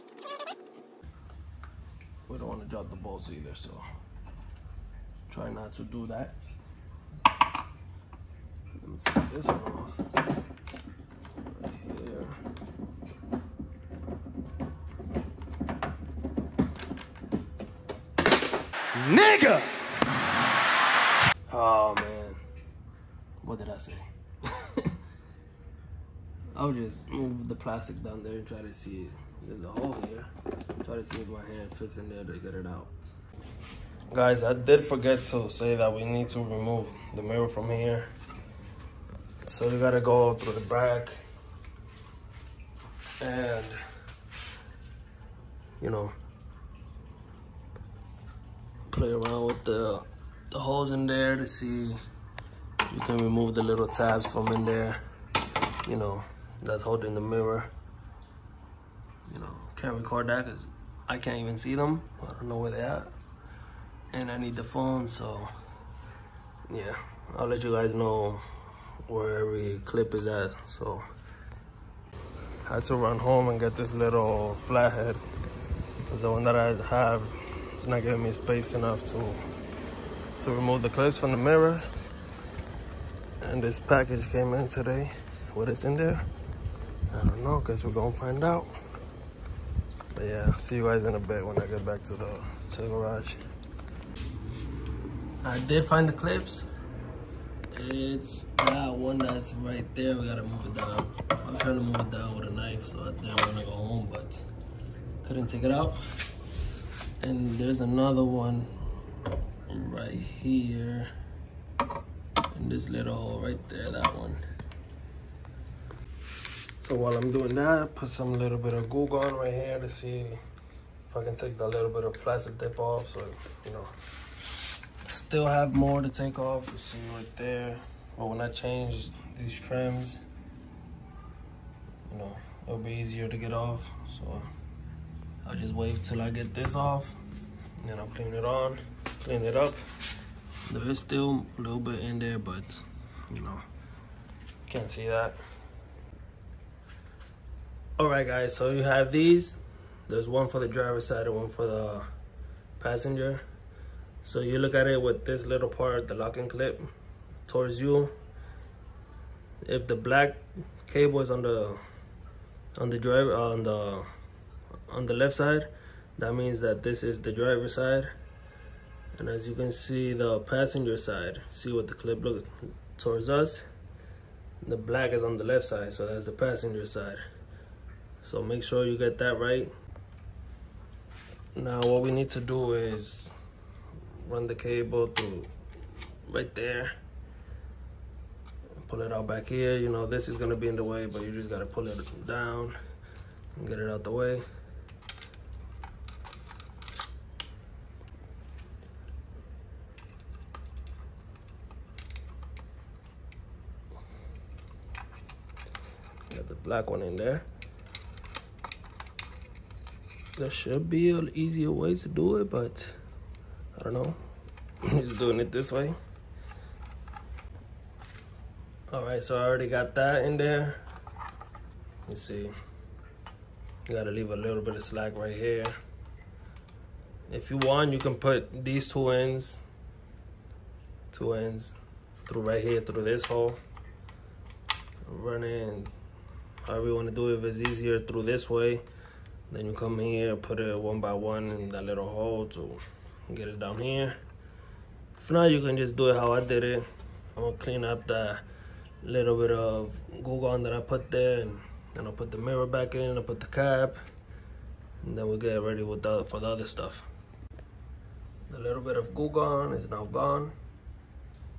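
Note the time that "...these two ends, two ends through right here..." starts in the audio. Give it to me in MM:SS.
03:48.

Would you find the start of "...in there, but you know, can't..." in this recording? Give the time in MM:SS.
02:22.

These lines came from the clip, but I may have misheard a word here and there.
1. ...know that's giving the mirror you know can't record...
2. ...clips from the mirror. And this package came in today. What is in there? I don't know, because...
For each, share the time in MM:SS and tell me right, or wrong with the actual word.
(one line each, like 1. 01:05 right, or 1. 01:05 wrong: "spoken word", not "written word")
1. 00:55 wrong: "holding", not "giving"
2. 01:20 right.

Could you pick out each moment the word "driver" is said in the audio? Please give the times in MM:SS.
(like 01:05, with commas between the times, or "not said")
02:30, 02:42, 02:47.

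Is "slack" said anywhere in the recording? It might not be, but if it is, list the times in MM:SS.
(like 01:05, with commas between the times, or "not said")
03:44.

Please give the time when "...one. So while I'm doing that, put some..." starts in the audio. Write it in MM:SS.
01:54.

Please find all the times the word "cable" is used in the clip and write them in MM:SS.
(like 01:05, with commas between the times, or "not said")
02:40, 03:04.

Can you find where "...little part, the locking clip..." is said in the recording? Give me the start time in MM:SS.
02:35.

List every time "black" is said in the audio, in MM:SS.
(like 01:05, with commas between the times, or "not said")
02:39, 02:54, 03:26.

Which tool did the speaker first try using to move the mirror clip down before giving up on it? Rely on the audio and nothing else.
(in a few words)
knife.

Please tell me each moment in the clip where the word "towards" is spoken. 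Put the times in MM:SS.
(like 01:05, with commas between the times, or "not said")
02:37, 02:52.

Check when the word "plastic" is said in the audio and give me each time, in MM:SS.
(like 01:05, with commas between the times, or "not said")
00:27, 02:02.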